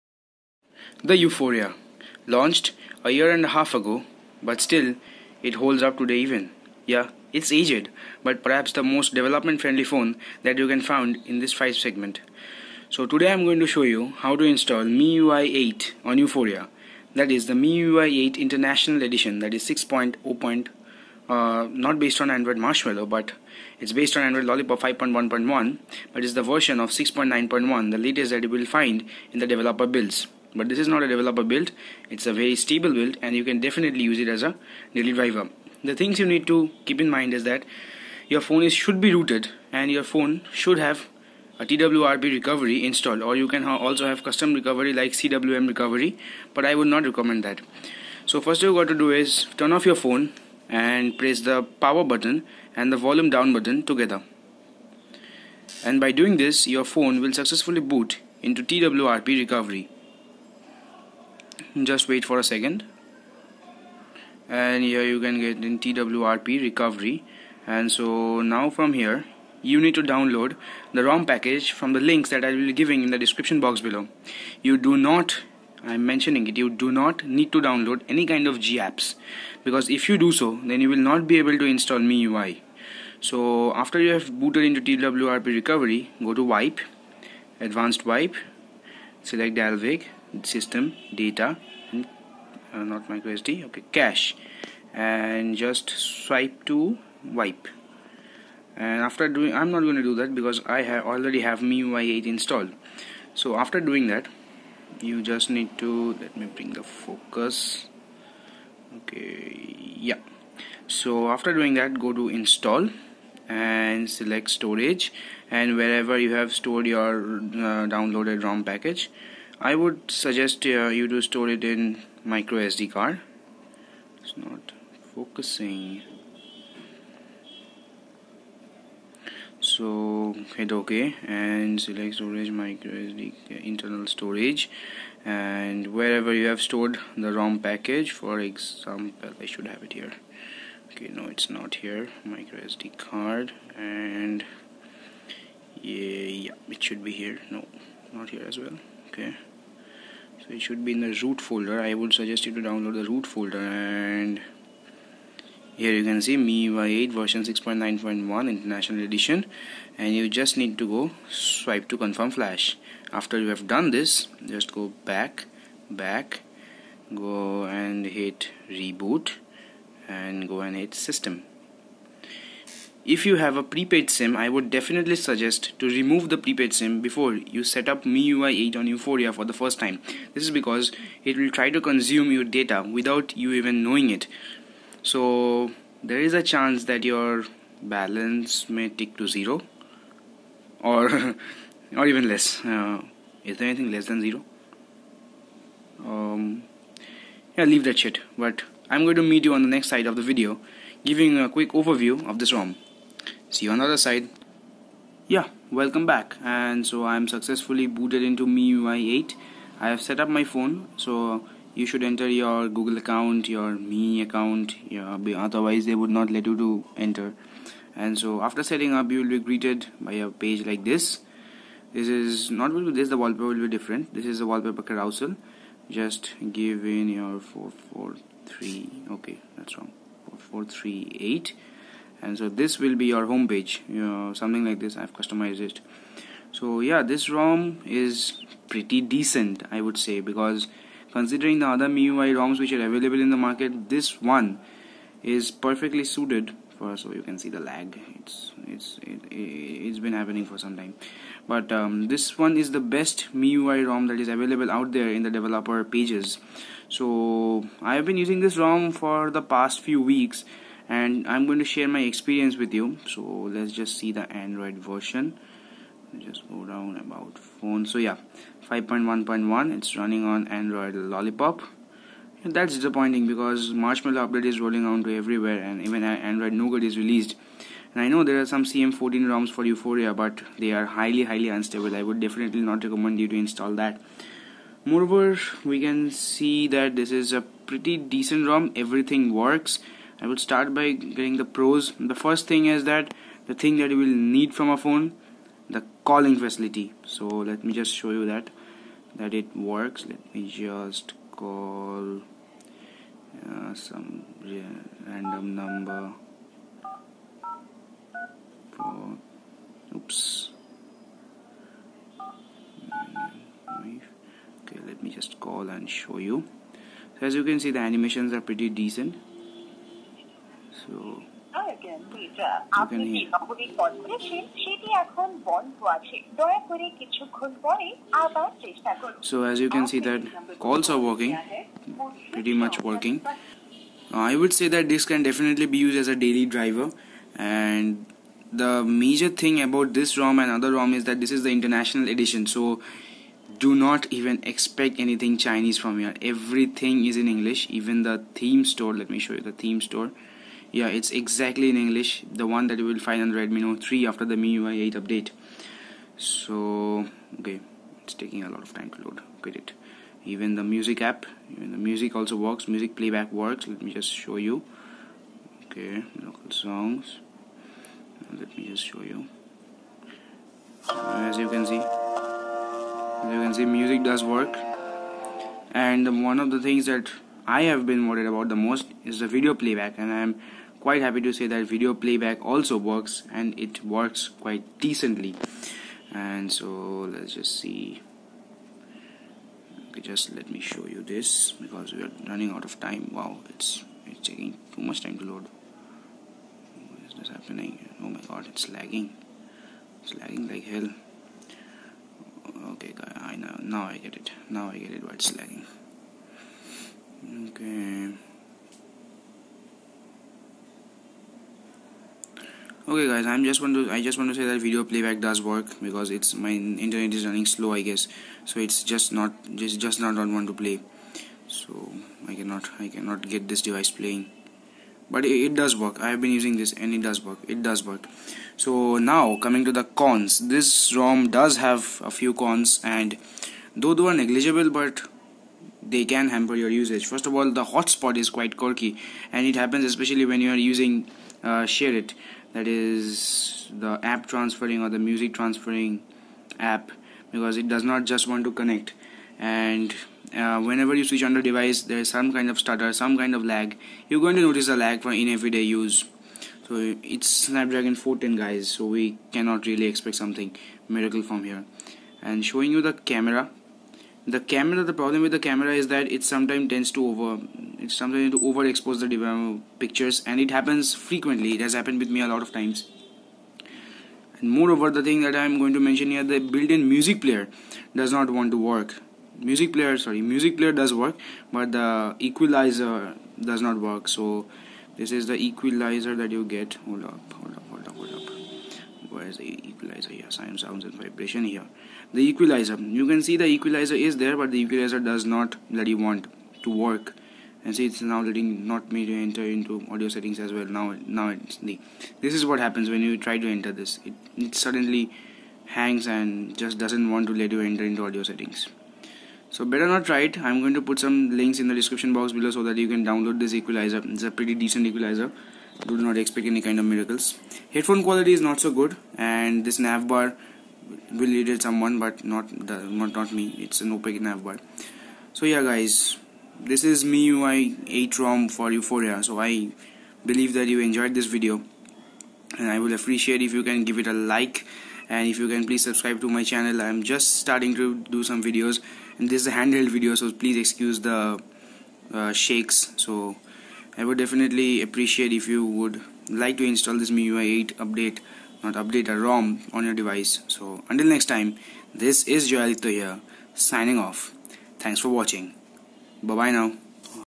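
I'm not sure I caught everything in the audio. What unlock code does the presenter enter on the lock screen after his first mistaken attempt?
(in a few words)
4438.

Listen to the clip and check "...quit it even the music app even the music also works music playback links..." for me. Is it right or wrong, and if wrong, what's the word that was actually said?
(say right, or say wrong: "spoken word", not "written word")
wrong: "works", not "links".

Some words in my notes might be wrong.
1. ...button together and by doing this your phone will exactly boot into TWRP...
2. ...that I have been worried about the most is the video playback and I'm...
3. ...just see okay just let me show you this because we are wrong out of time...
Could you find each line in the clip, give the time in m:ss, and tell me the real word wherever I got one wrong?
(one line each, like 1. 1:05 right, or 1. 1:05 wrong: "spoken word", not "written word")
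1. 0:53 wrong: "successfully", not "exactly"
2. 6:16 right
3. 6:27 wrong: "running", not "wrong".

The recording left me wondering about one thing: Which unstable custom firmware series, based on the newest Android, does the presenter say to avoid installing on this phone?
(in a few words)
CM14.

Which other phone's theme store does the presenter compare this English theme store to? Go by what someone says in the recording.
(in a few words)
Redmi Note 3.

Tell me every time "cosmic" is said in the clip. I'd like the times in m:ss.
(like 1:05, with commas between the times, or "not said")
not said.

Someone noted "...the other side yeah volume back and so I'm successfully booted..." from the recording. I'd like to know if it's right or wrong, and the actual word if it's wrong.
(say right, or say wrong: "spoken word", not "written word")
wrong: "welcome", not "volume".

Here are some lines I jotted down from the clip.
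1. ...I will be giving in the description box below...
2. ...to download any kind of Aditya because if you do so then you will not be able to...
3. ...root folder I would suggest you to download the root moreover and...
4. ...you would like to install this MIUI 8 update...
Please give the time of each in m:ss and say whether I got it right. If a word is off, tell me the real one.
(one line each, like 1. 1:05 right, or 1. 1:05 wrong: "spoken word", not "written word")
1. 1:12 right
2. 1:17 wrong: "GApps", not "Aditya"
3. 2:31 wrong: "folder", not "moreover"
4. 9:05 right.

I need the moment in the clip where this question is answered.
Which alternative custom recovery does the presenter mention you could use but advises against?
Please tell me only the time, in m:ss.
0:45.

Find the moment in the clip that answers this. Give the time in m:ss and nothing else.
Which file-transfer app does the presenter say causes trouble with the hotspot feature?
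7:21.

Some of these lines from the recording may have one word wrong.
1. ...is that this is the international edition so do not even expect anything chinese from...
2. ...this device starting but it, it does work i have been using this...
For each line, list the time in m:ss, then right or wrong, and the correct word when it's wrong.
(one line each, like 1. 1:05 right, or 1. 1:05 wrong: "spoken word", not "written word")
1. 5:40 right
2. 7:03 wrong: "playing", not "starting".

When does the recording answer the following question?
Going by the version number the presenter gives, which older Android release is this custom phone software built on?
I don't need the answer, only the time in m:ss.
0:24.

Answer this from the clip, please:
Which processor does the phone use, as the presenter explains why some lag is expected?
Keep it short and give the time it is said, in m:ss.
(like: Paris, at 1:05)
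Snapdragon 410, at 7:37.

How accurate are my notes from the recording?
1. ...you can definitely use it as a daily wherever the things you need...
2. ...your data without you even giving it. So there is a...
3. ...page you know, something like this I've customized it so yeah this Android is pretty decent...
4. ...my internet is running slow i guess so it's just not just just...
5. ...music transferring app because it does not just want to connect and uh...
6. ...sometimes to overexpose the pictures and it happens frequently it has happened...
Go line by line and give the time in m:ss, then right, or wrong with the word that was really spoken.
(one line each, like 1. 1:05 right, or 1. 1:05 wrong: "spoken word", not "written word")
1. 0:33 wrong: "driver", not "wherever"
2. 3:02 wrong: "knowing", not "giving"
3. 3:53 wrong: "ROM", not "Android"
4. 6:56 right
5. 7:24 right
6. 7:47 right.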